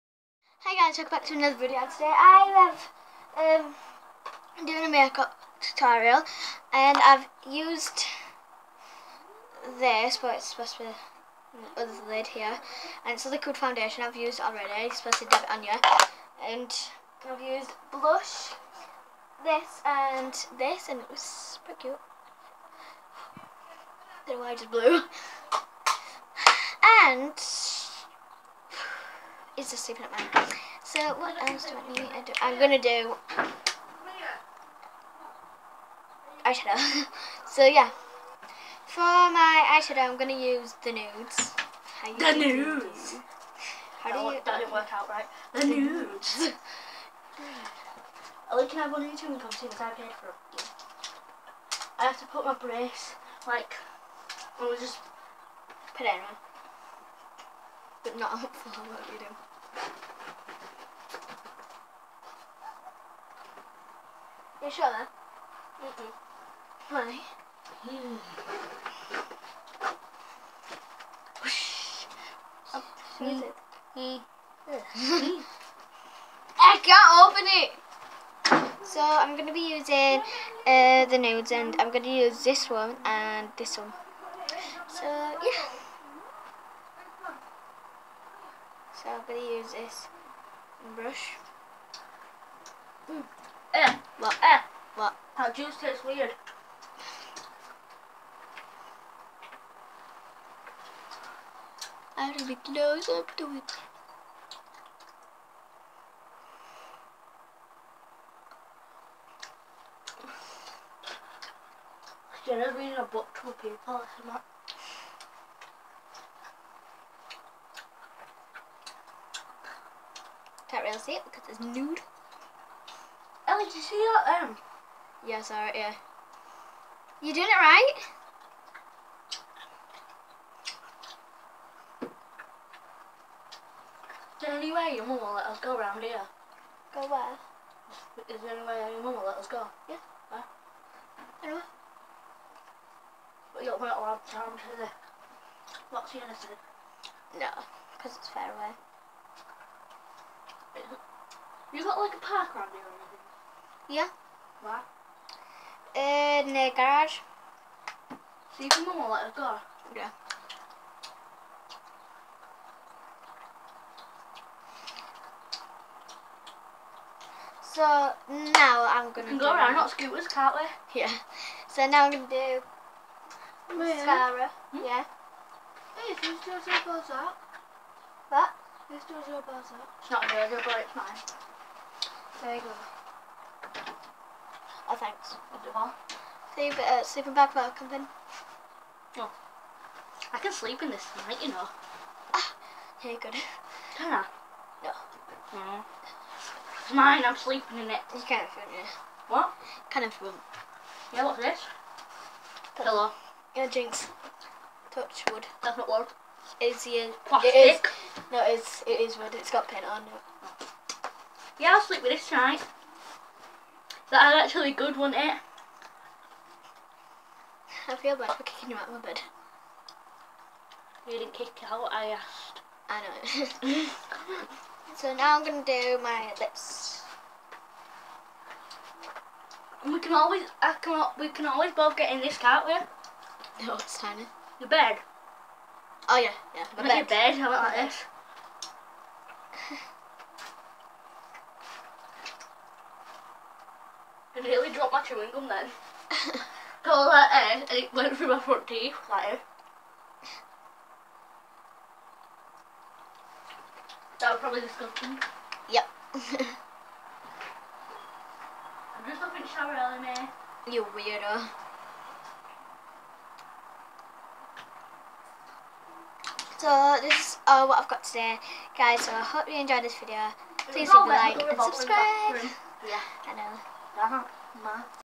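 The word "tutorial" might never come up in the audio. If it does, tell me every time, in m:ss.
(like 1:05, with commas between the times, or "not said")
0:05.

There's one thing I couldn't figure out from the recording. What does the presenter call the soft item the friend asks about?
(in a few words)
Pillow.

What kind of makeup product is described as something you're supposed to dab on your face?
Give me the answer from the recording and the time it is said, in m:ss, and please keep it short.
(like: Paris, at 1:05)
Liquid foundation, at 0:13.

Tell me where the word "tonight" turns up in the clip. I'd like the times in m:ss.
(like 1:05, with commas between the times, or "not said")
3:11, 3:32.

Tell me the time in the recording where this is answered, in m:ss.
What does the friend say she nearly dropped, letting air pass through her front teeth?
4:05.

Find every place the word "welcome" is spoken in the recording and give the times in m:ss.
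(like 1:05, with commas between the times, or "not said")
0:00.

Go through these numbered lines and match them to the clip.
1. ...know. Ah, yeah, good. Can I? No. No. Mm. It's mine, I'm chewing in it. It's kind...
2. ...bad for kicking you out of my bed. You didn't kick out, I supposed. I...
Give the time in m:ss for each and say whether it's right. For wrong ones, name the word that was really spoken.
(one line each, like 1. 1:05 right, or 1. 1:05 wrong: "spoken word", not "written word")
1. 3:11 wrong: "sleeping", not "chewing"
2. 3:38 wrong: "asked", not "supposed".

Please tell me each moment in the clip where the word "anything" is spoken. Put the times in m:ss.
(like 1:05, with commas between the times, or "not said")
2:32.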